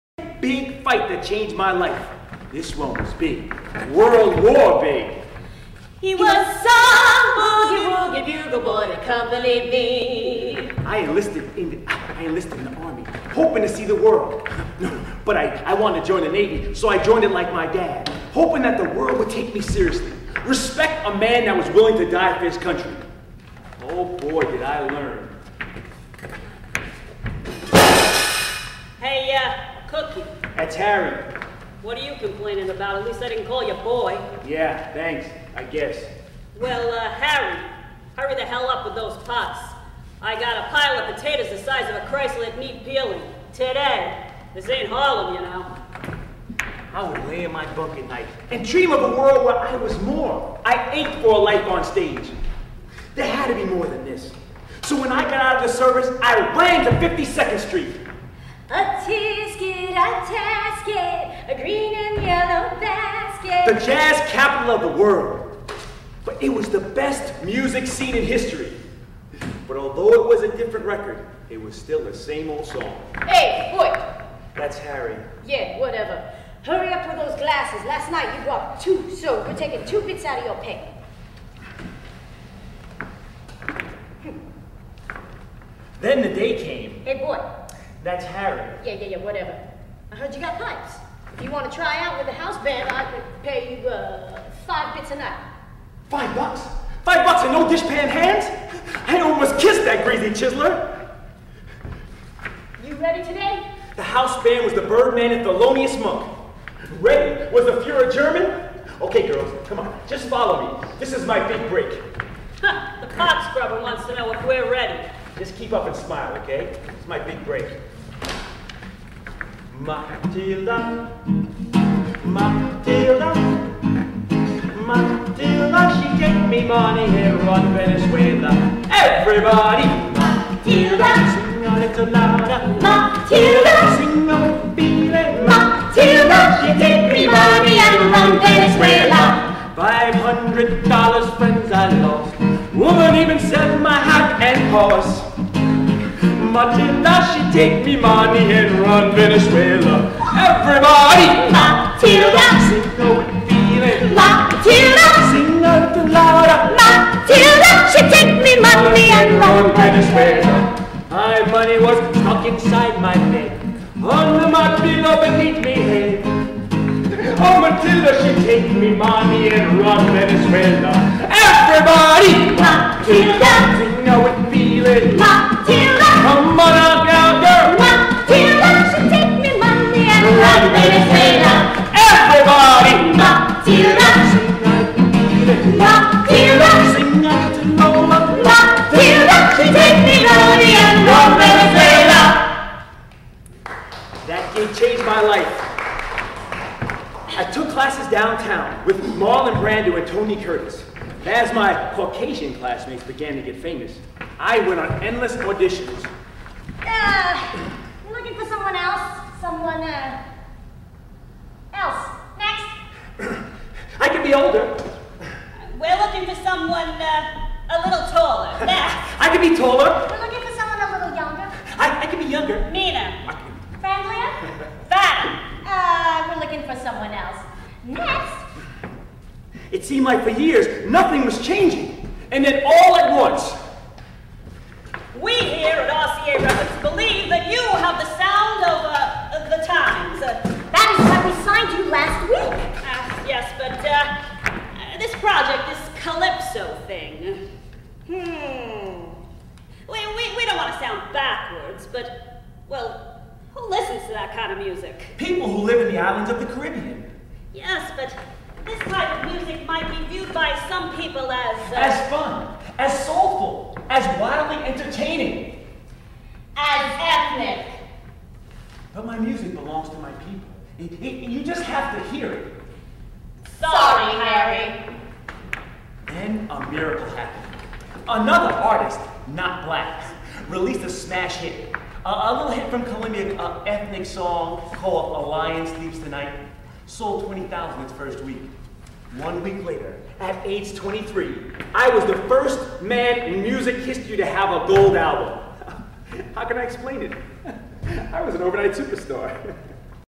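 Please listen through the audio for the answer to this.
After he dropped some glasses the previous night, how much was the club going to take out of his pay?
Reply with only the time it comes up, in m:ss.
1:19.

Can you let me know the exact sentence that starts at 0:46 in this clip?
I would lay in my bunk at night and dream of a world where I was more.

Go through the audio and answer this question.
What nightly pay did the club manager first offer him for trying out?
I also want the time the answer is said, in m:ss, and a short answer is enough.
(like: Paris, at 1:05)
five bits, at 1:34.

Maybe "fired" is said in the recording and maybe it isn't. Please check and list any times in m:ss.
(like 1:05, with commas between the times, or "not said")
not said.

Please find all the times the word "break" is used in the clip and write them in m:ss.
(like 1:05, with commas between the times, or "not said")
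1:51, 1:57.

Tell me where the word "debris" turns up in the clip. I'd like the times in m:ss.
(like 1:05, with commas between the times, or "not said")
not said.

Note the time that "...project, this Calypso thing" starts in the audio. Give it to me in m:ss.
4:05.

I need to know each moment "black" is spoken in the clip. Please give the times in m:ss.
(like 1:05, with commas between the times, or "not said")
4:39.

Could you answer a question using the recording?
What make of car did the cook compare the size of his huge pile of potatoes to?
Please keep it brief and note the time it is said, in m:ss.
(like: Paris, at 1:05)
Chrysler, at 0:42.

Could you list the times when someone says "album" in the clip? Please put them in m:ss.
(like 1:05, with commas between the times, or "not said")
4:54.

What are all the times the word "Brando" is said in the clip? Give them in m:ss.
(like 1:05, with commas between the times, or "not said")
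3:19.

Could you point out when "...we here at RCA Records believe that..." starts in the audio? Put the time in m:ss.
3:55.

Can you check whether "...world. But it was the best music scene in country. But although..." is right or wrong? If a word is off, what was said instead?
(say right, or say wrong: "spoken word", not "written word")
wrong: "history", not "country".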